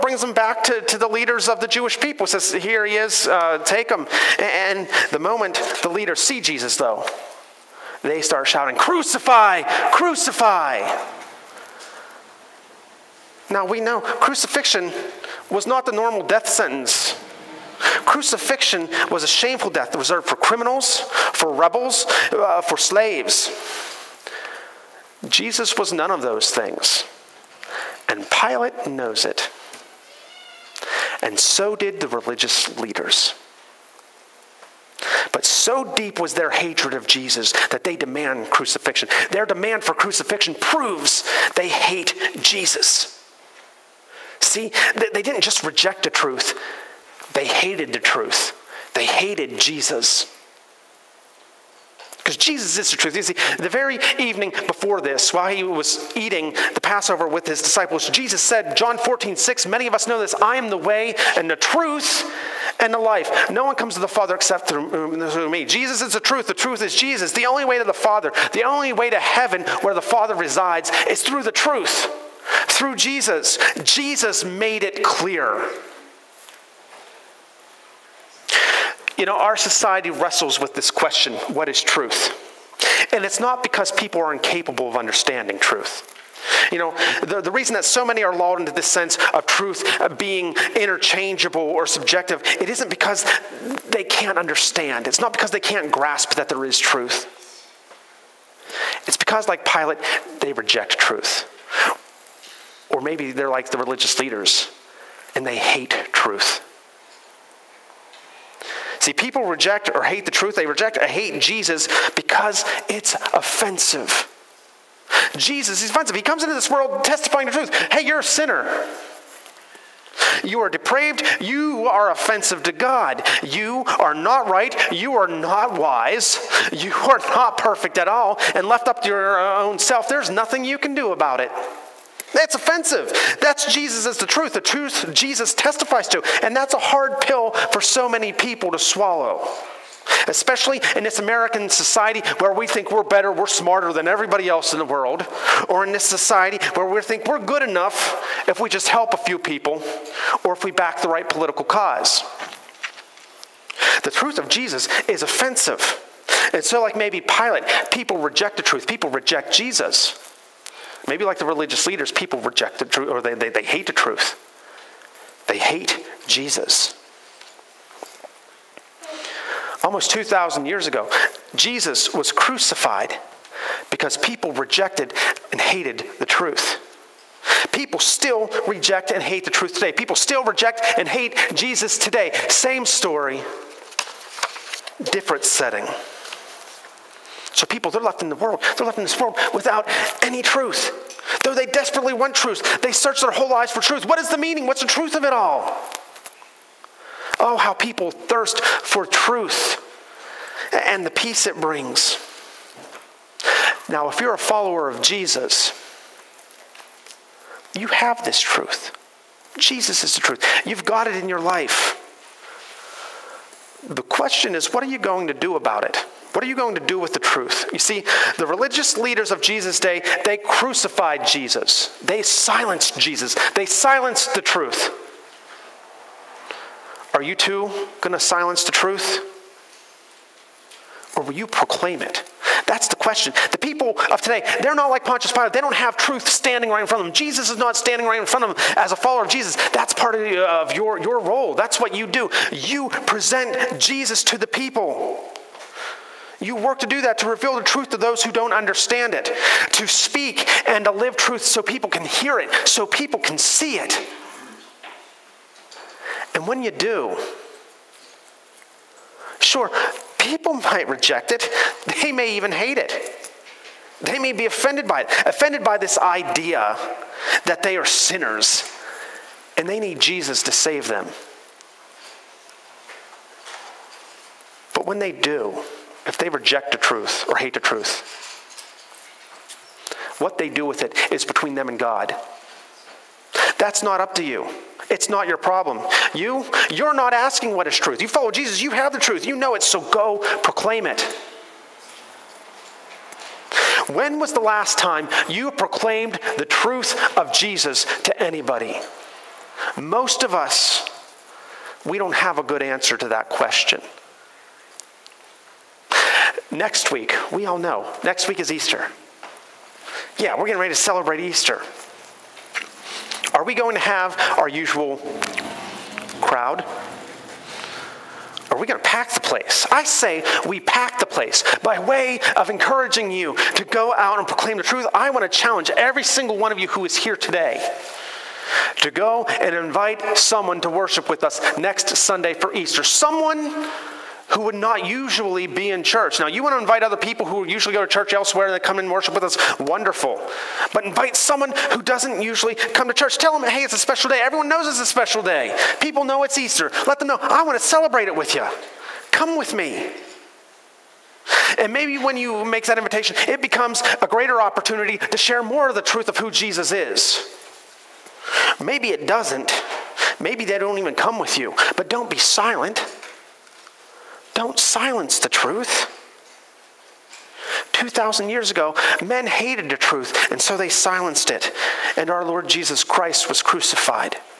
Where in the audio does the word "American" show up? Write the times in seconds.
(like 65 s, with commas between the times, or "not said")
141 s.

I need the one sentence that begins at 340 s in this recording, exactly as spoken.
But invite someone who doesn't usually come to church.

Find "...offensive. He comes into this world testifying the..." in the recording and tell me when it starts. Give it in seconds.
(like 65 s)
115 s.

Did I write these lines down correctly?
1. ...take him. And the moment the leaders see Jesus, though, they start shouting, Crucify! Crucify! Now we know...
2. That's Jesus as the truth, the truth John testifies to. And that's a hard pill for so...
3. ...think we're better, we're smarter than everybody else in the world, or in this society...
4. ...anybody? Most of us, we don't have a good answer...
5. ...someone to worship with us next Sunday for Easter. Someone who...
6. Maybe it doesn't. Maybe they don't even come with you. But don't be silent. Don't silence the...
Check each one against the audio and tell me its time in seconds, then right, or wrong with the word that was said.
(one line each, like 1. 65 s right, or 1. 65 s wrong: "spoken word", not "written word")
1. 3 s right
2. 133 s wrong: "Jesus", not "John"
3. 142 s right
4. 298 s right
5. 330 s right
6. 358 s right.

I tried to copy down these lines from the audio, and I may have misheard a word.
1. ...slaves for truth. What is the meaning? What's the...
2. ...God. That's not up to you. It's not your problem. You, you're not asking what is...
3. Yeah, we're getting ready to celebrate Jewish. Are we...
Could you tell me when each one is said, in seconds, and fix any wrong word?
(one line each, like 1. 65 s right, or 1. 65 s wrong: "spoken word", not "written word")
1. 193 s wrong: "lives", not "slaves"
2. 281 s right
3. 310 s wrong: "Easter", not "Jewish".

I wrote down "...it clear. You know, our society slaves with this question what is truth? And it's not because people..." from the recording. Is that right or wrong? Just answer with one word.
wrong.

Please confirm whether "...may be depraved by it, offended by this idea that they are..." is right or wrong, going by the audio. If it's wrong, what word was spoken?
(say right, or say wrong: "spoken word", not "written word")
wrong: "offended", not "depraved".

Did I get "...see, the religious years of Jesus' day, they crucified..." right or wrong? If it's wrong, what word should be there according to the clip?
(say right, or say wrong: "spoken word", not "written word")
wrong: "leaders", not "years".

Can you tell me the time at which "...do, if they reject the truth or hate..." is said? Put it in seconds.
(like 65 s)
275 s.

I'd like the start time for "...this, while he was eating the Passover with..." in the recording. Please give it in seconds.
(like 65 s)
55 s.